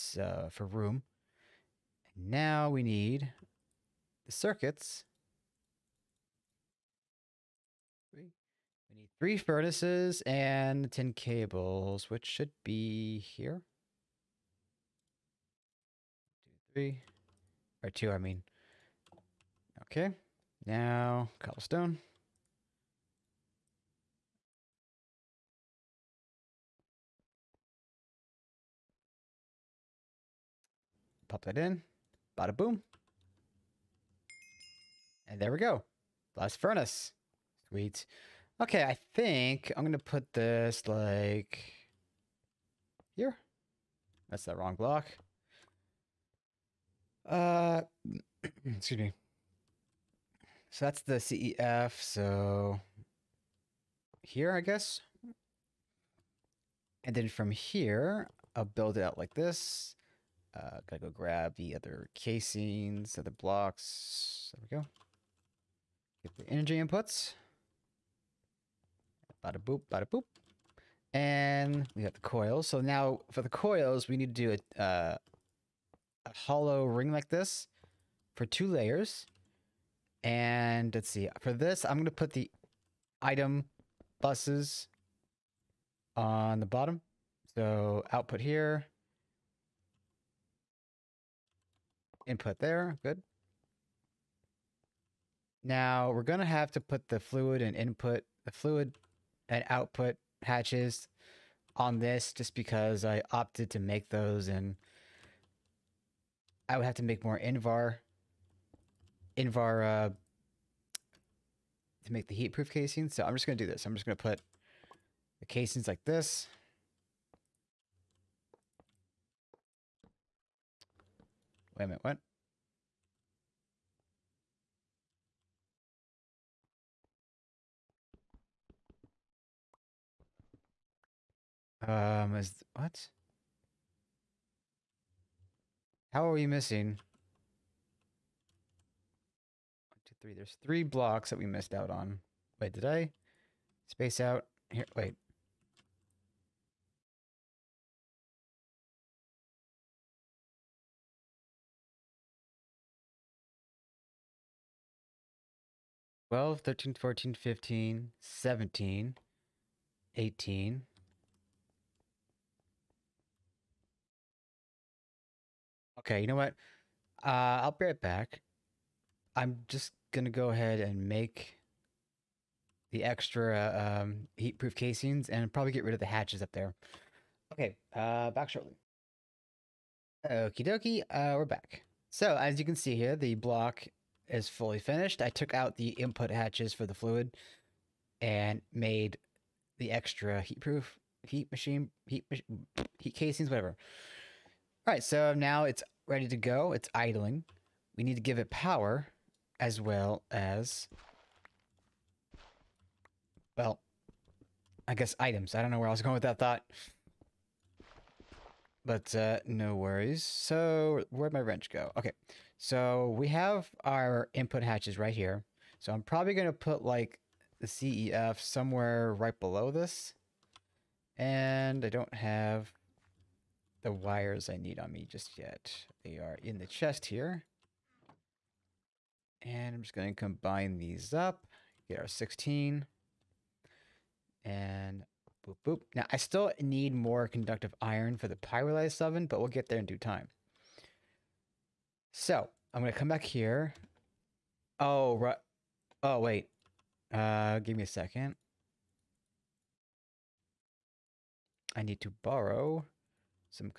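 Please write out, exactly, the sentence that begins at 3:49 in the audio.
And I'm just going to combine these up, get our 16.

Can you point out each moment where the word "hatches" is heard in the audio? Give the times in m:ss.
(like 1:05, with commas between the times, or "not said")
1:40, 2:56, 3:06, 3:34.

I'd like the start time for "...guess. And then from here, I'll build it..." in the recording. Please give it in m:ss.
0:54.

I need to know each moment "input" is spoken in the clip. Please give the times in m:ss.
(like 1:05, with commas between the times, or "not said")
1:06, 1:32, 1:37, 3:05, 3:34.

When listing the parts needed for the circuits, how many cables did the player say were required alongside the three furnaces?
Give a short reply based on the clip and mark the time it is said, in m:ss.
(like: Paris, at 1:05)
10, at 0:10.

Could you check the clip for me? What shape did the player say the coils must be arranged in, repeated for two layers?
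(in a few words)
A hollow ring.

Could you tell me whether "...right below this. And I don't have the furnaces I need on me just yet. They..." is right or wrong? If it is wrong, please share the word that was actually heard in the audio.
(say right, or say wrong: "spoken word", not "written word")
wrong: "wires", not "furnaces".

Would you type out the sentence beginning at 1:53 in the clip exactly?
So I'm just going to do this.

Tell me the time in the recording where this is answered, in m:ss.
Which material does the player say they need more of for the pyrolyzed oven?
3:57.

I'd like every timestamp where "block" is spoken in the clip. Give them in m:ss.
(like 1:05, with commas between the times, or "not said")
0:44, 1:03, 2:20, 3:03.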